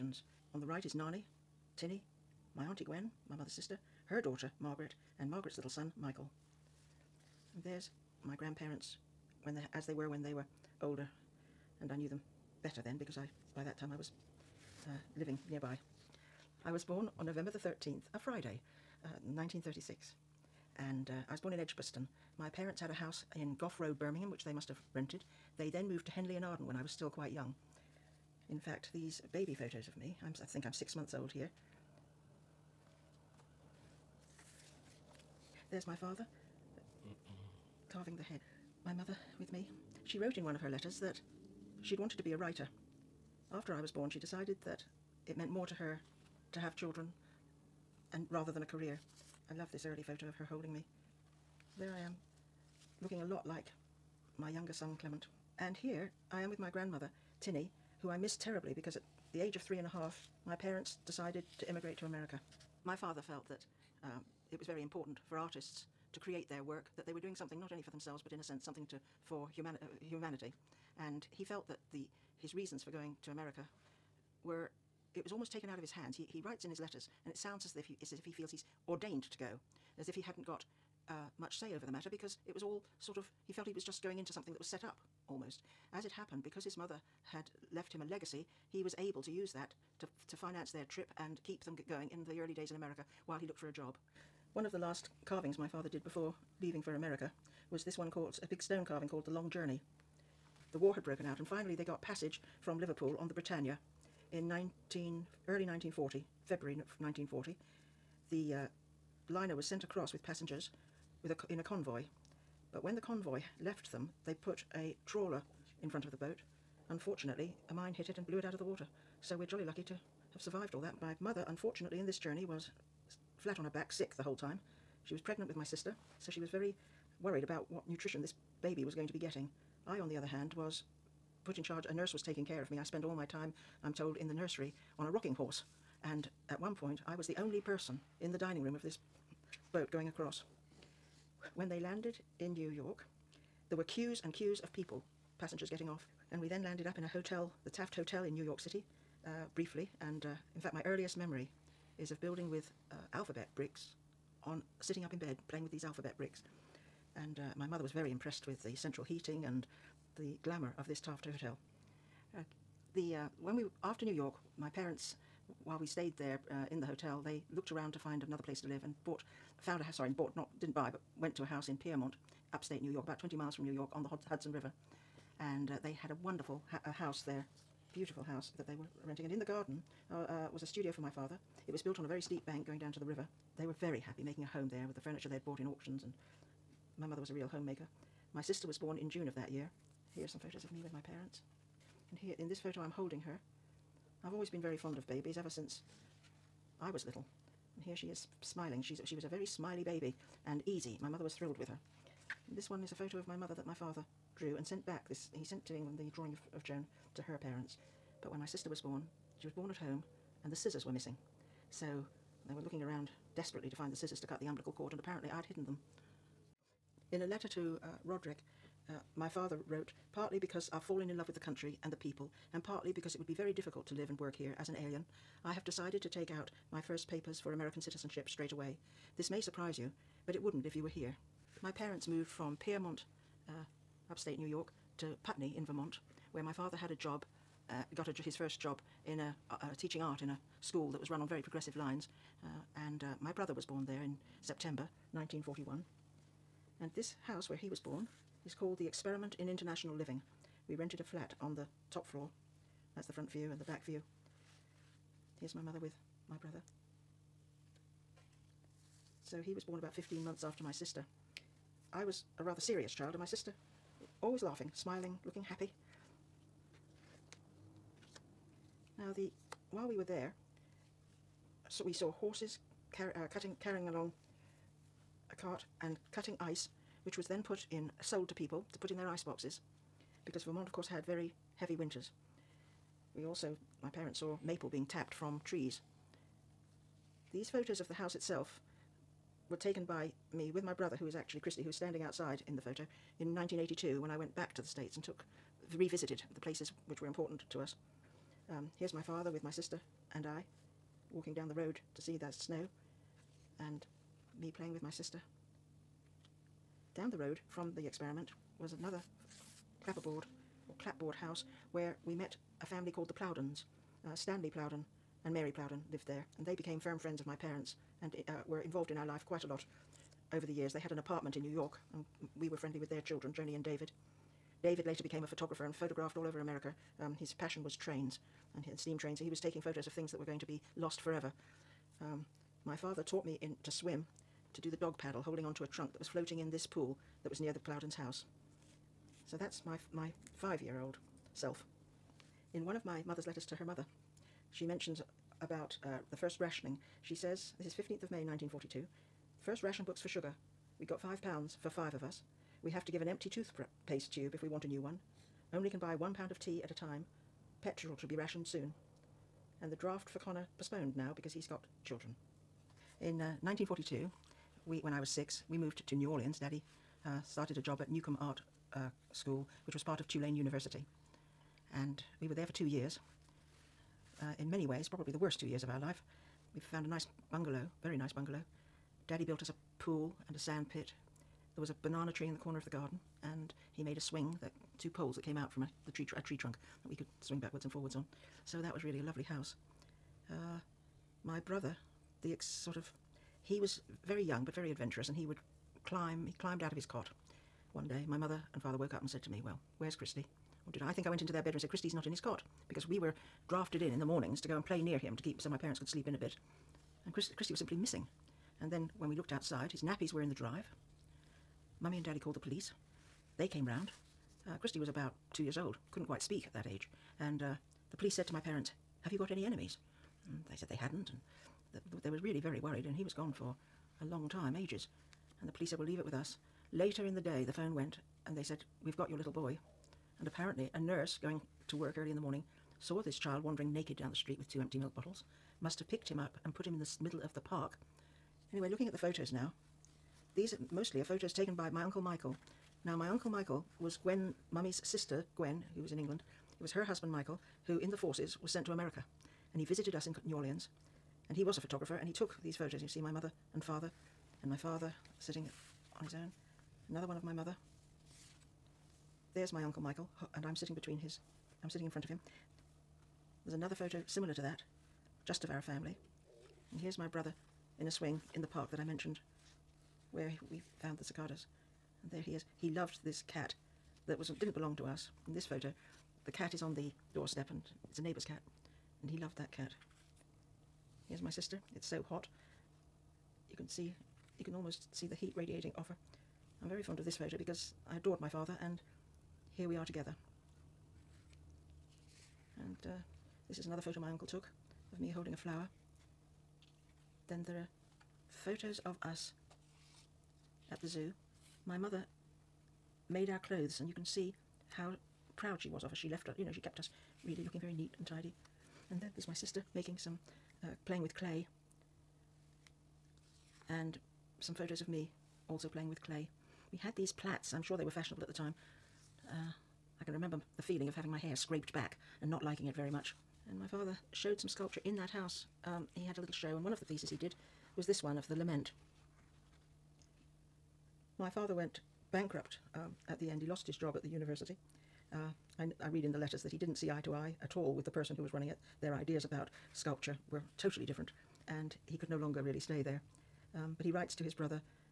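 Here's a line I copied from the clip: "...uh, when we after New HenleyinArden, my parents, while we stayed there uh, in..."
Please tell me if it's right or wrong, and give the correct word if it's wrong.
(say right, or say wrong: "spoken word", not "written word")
wrong: "York", not "HenleyinArden".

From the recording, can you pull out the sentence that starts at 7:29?
And he visited us in New Orleans and he was a photographer and he took these photos.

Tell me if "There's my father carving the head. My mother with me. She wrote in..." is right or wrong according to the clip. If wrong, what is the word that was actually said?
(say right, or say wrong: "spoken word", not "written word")
right.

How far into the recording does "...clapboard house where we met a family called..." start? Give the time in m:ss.
5:10.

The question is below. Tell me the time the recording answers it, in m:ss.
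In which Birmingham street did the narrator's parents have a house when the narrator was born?
0:23.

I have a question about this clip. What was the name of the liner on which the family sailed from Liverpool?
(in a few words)
Britannia.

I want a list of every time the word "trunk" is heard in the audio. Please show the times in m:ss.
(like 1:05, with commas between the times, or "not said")
5:35, 6:26.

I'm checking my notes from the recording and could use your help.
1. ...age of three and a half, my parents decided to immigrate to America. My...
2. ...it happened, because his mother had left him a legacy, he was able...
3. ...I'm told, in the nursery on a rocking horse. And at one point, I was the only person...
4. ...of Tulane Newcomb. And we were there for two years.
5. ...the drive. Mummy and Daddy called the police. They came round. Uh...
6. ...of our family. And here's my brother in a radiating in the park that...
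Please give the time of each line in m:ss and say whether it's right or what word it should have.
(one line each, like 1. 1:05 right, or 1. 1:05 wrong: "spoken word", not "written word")
1. 0:59 right
2. 1:26 right
3. 2:13 right
4. 6:09 wrong: "University", not "Newcomb"
5. 6:50 right
6. 7:45 wrong: "swing", not "radiating".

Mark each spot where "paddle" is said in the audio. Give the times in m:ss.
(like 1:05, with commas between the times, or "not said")
5:34.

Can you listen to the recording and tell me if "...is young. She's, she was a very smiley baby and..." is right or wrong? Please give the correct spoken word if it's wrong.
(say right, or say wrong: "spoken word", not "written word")
wrong: "smiling", not "young".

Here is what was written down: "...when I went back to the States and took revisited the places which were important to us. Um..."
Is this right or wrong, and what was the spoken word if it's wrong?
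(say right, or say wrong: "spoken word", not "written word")
right.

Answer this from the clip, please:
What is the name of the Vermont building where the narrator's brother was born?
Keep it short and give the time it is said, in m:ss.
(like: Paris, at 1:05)
The Experiment in International Living, at 4:08.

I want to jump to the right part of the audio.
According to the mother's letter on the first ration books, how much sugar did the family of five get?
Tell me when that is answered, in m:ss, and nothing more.
5:50.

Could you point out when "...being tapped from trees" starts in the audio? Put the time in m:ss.
4:44.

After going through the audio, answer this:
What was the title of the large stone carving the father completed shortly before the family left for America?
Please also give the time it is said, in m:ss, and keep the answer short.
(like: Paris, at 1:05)
The Long Journey, at 1:39.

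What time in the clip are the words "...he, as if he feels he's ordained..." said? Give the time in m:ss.
1:17.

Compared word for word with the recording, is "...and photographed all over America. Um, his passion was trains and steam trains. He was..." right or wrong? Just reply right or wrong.
right.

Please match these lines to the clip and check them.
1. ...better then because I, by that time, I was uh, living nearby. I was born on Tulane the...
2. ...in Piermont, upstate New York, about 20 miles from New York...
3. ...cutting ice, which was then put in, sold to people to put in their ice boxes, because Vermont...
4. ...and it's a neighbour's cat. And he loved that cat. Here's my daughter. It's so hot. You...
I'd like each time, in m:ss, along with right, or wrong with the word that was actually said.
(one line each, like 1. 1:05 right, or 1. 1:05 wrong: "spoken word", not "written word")
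1. 0:12 wrong: "November", not "Tulane"
2. 2:51 right
3. 4:36 right
4. 7:57 wrong: "sister", not "daughter".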